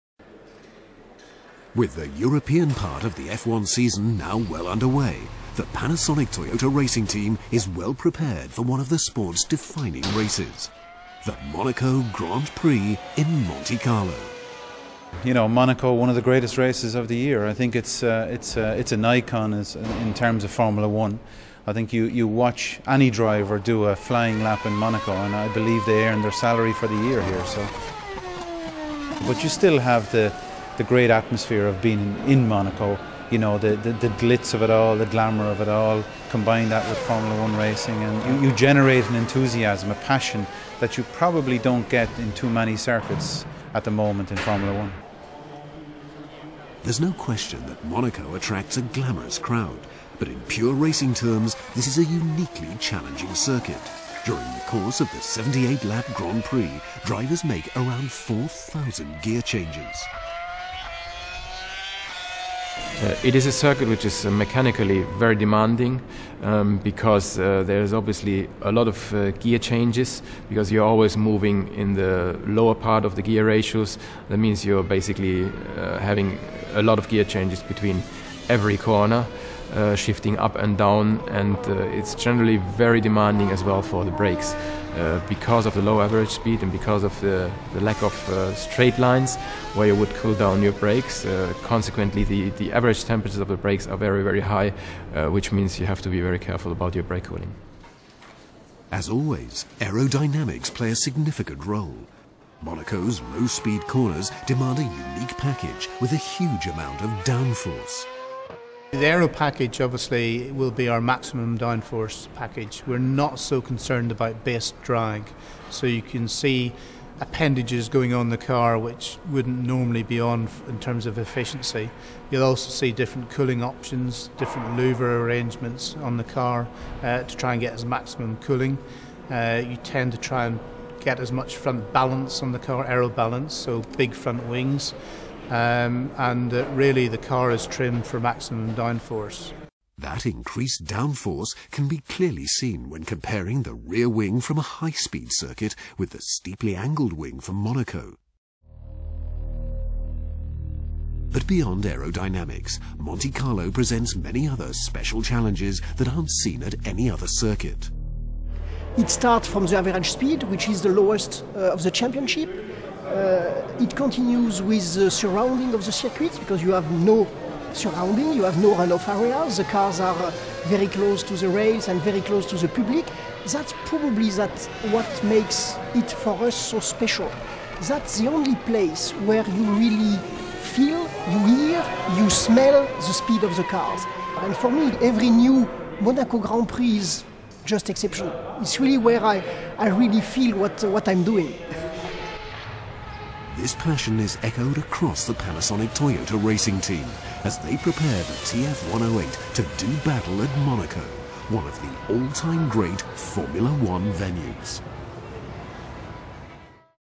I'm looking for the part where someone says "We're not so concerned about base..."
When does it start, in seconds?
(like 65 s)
112 s.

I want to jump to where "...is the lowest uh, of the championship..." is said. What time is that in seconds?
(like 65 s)
160 s.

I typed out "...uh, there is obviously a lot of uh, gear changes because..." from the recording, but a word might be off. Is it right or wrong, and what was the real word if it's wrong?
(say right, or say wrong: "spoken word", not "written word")
right.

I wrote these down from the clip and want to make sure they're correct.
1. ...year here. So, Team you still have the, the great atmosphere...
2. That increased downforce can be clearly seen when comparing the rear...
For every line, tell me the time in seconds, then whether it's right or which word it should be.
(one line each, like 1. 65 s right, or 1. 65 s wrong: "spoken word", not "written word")
1. 27 s wrong: "But", not "Team"
2. 139 s right.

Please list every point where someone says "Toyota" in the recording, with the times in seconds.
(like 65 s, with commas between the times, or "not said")
6 s, 195 s.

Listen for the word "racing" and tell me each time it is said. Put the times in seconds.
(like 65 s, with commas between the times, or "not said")
6 s, 37 s, 50 s, 196 s.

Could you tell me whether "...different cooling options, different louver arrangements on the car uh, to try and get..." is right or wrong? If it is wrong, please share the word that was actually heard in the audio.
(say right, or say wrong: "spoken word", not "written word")
right.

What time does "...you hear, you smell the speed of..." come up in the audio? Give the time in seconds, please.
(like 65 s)
181 s.